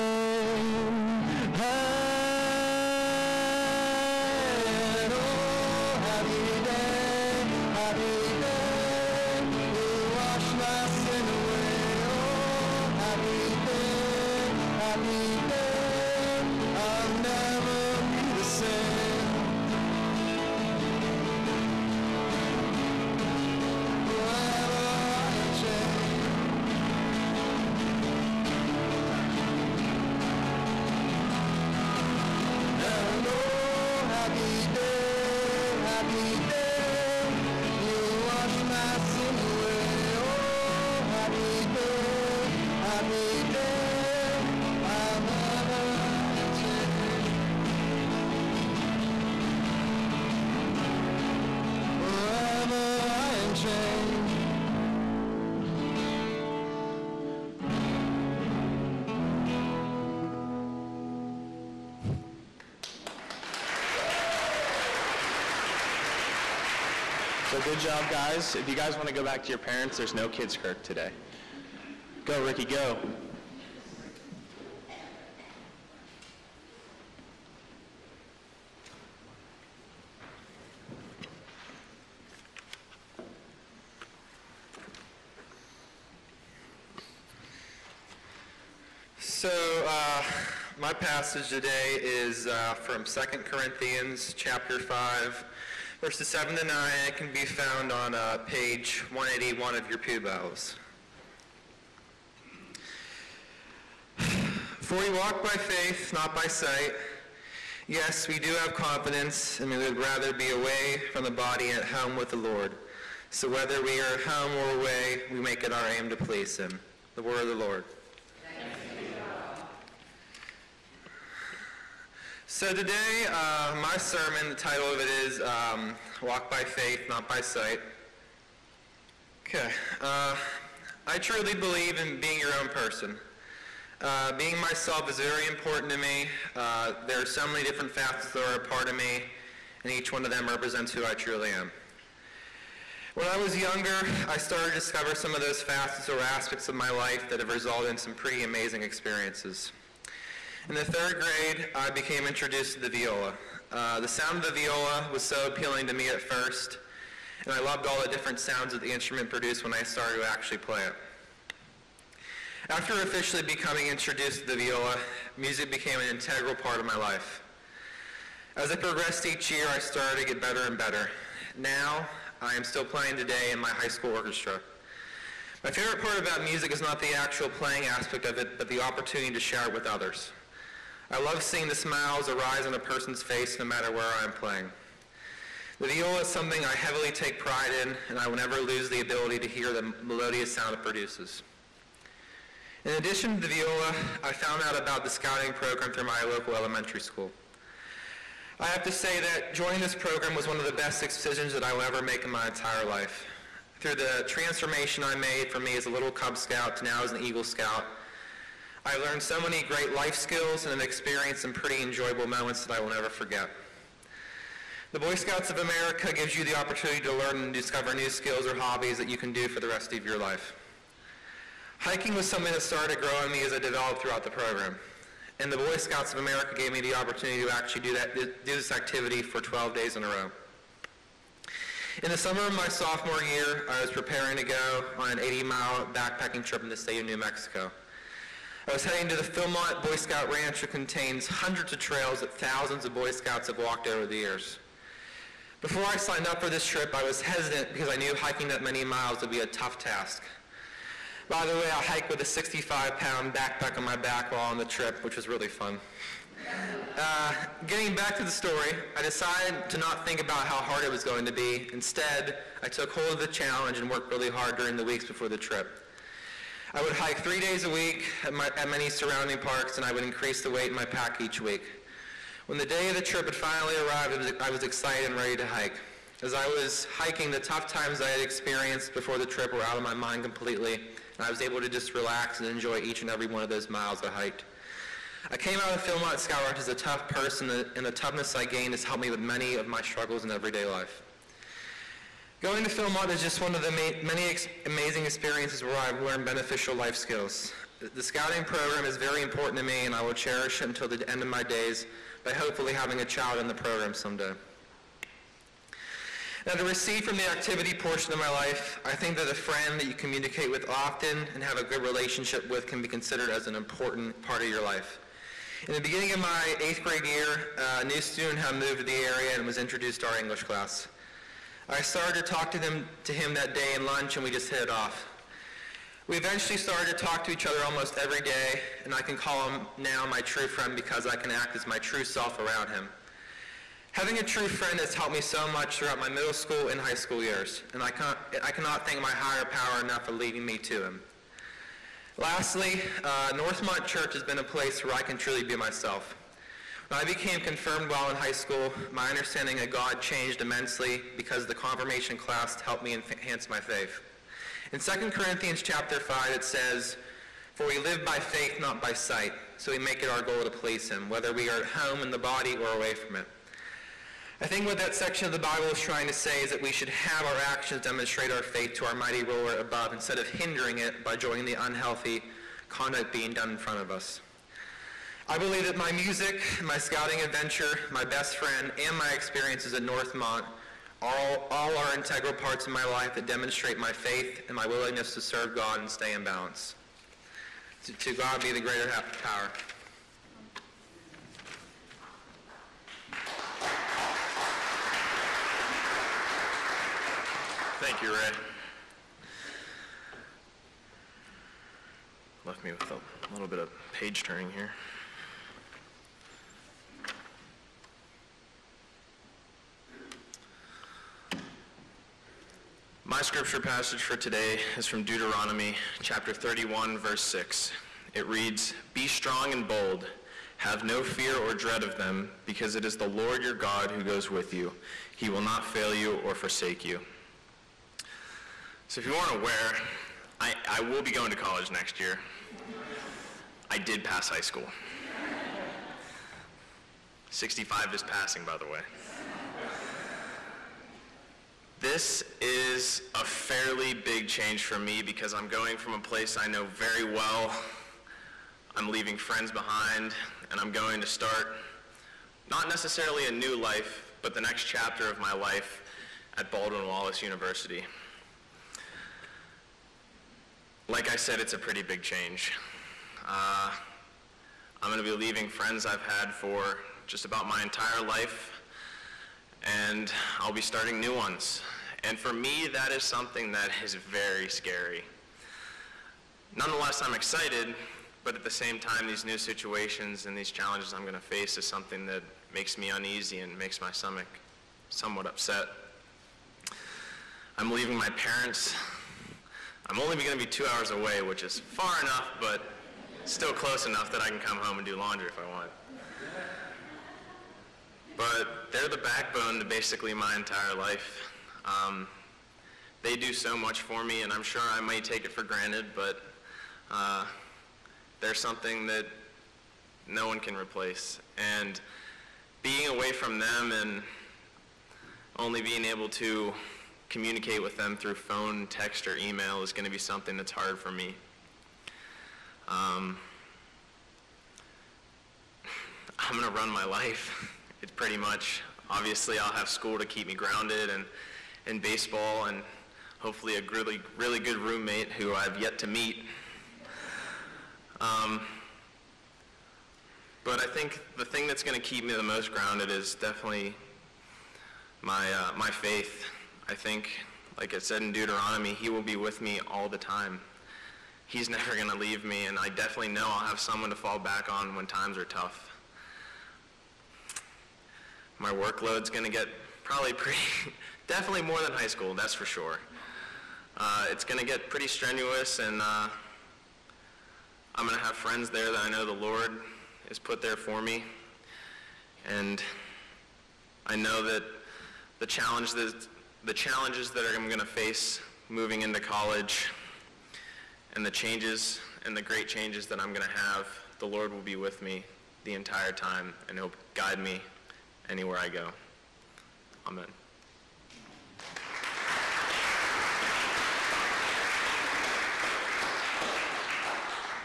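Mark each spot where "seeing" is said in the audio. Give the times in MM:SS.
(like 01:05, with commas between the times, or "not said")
03:01.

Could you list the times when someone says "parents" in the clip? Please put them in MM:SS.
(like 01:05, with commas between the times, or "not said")
01:09, 08:08.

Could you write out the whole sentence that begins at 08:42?
Um, I'm going to run my life.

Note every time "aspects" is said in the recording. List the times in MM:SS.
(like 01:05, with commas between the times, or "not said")
02:26, 02:57.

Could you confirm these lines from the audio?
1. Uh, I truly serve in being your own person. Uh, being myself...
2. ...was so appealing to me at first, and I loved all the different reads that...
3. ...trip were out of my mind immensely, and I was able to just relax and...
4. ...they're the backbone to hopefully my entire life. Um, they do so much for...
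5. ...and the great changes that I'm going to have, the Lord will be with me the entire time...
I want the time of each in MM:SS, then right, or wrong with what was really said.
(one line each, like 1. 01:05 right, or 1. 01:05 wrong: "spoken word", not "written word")
1. 02:09 wrong: "believe", not "serve"
2. 02:35 wrong: "sounds", not "reads"
3. 04:39 wrong: "completely", not "immensely"
4. 08:18 wrong: "basically", not "hopefully"
5. 09:42 right.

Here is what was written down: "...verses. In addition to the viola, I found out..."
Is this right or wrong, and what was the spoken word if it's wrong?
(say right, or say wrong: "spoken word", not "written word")
wrong: "produces", not "verses".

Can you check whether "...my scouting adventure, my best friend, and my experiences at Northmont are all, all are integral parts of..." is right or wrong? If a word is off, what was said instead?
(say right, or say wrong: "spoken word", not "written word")
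right.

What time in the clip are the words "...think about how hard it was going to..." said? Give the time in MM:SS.
04:20.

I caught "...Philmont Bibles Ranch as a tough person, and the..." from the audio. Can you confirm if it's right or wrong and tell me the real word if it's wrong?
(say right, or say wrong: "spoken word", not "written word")
wrong: "Scout", not "Bibles".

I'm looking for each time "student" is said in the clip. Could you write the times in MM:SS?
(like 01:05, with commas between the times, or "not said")
05:18.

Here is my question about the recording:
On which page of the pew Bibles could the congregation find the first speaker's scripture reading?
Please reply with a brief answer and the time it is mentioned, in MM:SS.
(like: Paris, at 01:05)
181, at 01:38.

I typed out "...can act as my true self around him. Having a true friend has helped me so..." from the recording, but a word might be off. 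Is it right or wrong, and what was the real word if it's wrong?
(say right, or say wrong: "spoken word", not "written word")
right.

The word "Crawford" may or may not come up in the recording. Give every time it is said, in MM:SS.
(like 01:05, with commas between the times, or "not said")
not said.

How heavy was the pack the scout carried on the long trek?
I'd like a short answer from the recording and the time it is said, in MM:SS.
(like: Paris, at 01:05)
65 pounds, at 04:12.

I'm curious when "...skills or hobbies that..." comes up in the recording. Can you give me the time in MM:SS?
03:38.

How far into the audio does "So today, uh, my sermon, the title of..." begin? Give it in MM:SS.
02:02.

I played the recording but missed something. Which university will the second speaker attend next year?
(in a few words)
Baldwin Wallace University.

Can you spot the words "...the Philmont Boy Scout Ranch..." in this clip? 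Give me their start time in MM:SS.
03:59.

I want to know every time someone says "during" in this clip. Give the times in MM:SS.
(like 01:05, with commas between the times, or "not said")
04:24.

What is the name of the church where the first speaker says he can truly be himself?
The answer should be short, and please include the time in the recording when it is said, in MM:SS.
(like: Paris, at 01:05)
Northmont Church, at 05:43.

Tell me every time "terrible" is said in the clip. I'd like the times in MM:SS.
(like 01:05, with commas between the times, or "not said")
not said.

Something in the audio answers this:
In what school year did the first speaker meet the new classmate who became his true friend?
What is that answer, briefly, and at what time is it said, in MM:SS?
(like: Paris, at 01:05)
Eighth grade, at 05:16.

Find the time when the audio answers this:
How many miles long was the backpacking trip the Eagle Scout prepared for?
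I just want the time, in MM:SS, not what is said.
03:55.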